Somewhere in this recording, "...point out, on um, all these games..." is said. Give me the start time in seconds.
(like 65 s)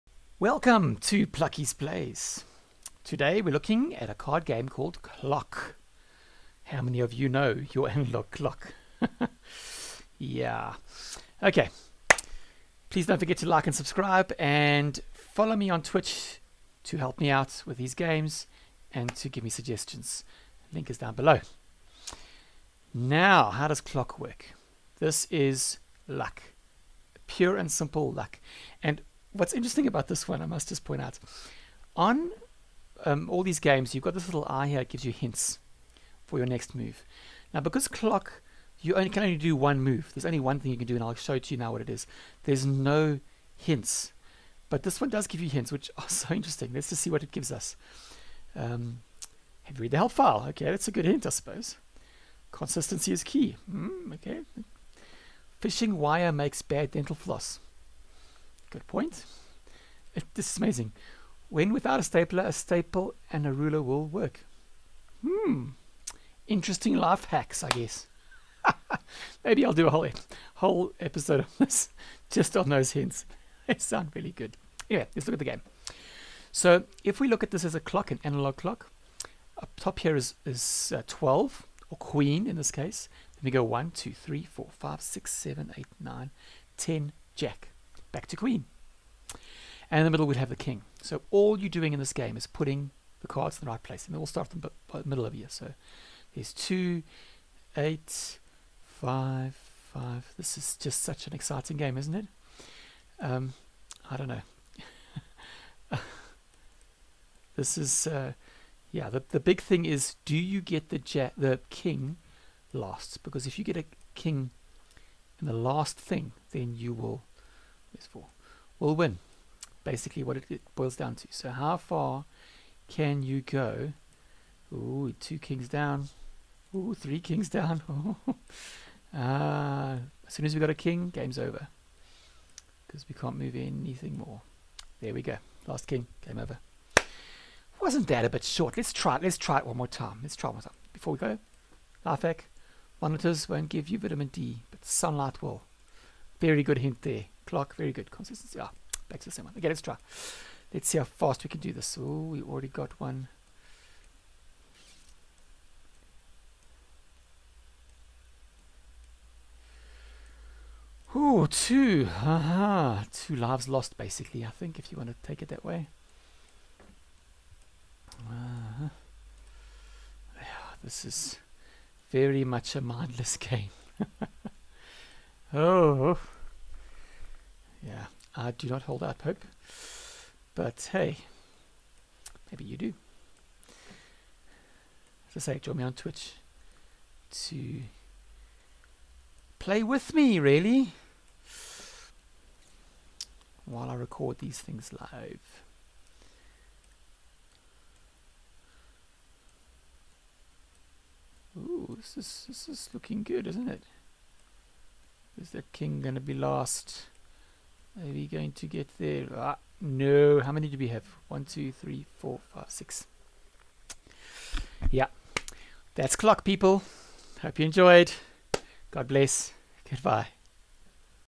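30 s.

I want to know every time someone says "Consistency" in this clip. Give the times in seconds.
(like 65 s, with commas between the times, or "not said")
52 s, 148 s.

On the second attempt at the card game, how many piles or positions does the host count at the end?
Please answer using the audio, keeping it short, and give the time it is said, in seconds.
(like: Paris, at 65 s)
6, at 212 s.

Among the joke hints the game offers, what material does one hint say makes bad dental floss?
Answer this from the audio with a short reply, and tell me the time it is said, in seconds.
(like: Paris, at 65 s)
Fishing wire, at 55 s.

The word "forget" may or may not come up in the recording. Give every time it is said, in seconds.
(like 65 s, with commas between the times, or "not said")
13 s.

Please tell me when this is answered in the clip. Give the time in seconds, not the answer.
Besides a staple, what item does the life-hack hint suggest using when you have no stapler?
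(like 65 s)
63 s.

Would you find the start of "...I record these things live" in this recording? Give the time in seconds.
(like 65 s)
193 s.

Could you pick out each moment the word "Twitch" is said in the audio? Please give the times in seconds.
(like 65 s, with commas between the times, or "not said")
15 s, 185 s.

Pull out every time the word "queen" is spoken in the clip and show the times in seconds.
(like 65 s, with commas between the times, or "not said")
81 s, 88 s.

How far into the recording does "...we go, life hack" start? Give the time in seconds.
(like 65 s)
141 s.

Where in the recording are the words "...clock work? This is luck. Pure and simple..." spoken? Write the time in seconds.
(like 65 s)
23 s.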